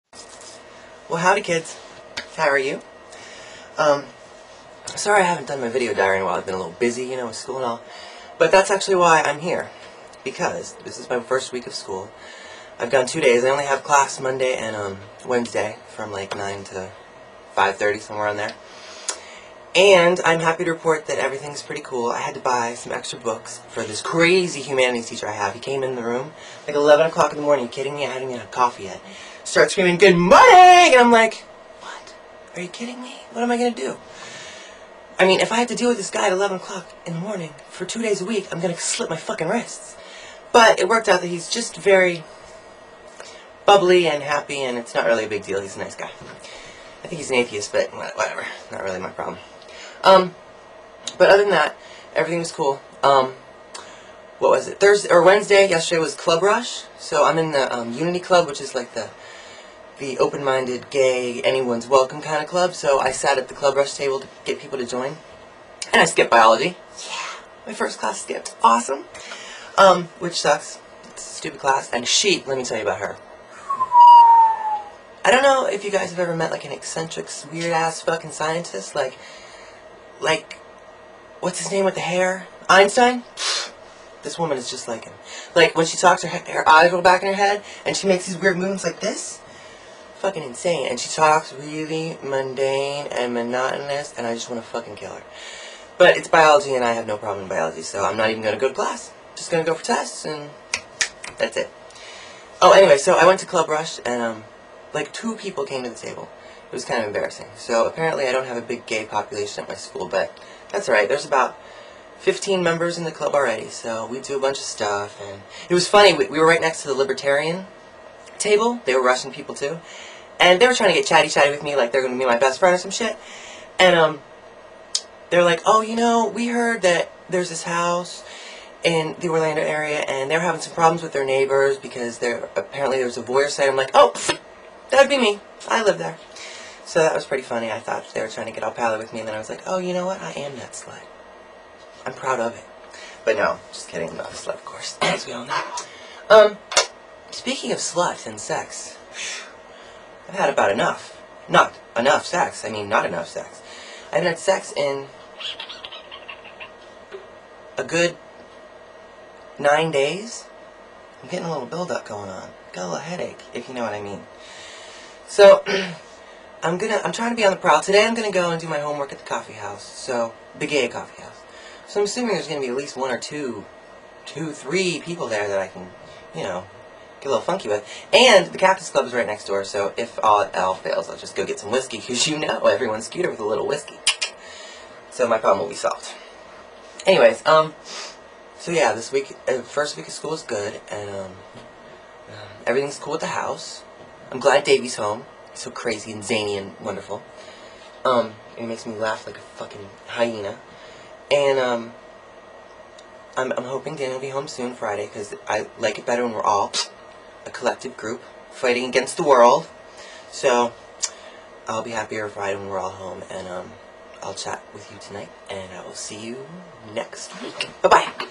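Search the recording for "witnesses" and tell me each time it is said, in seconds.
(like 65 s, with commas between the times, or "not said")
not said.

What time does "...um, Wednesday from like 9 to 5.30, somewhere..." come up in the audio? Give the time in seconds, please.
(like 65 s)
14 s.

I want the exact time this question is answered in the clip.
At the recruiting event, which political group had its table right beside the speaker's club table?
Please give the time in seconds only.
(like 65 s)
116 s.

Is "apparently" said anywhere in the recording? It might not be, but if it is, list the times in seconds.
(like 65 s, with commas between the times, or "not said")
107 s, 132 s.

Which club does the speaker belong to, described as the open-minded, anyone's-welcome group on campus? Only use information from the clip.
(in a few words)
Unity Club.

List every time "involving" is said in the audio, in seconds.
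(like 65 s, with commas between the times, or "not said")
not said.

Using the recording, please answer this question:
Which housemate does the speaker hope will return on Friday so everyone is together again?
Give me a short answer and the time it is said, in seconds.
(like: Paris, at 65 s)
Dan, at 203 s.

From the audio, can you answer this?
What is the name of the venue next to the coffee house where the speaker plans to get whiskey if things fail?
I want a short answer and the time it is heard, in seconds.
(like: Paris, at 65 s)
Cactus Club, at 178 s.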